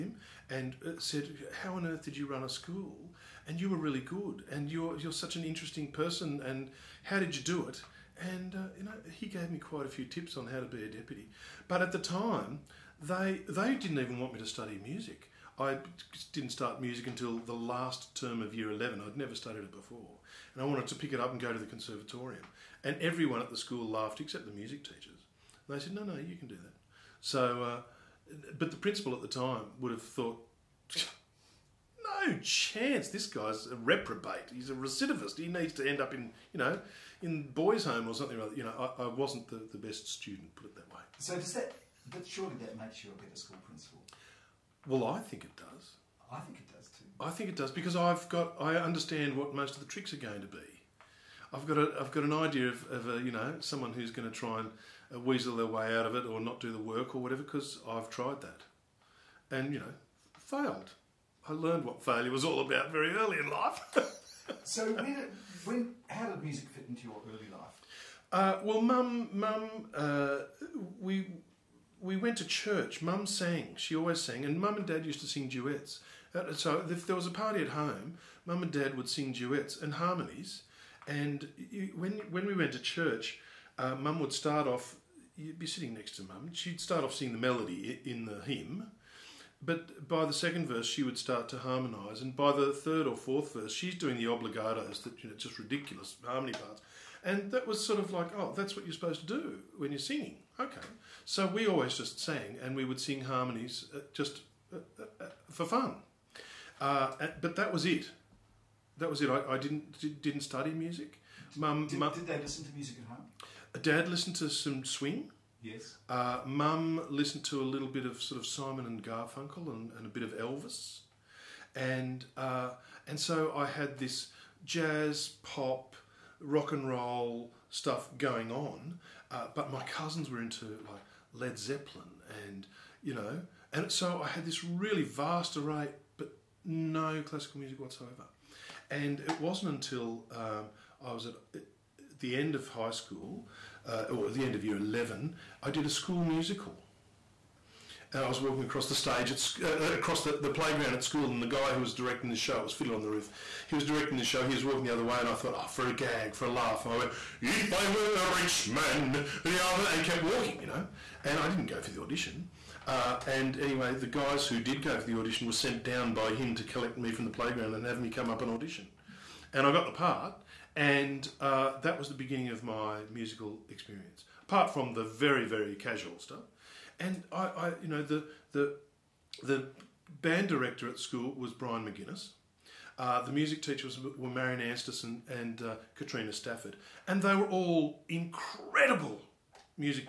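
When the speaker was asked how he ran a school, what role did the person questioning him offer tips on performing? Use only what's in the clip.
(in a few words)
Deputy.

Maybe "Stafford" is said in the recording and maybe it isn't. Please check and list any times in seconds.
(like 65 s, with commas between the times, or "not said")
186 s.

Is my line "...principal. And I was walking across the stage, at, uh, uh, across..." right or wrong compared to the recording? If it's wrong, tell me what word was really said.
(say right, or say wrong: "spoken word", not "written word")
wrong: "musical", not "principal".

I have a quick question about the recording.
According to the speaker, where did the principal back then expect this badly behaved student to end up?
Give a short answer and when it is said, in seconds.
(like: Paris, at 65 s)
Boys' home, at 37 s.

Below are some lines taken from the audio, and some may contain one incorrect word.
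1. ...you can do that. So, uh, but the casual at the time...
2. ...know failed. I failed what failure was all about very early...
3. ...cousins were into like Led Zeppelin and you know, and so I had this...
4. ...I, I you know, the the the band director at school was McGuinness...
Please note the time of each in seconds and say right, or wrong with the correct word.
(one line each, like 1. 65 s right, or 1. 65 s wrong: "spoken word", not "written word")
1. 26 s wrong: "principal", not "casual"
2. 59 s wrong: "learned", not "failed"
3. 129 s right
4. 177 s wrong: "Brian", not "McGuinness".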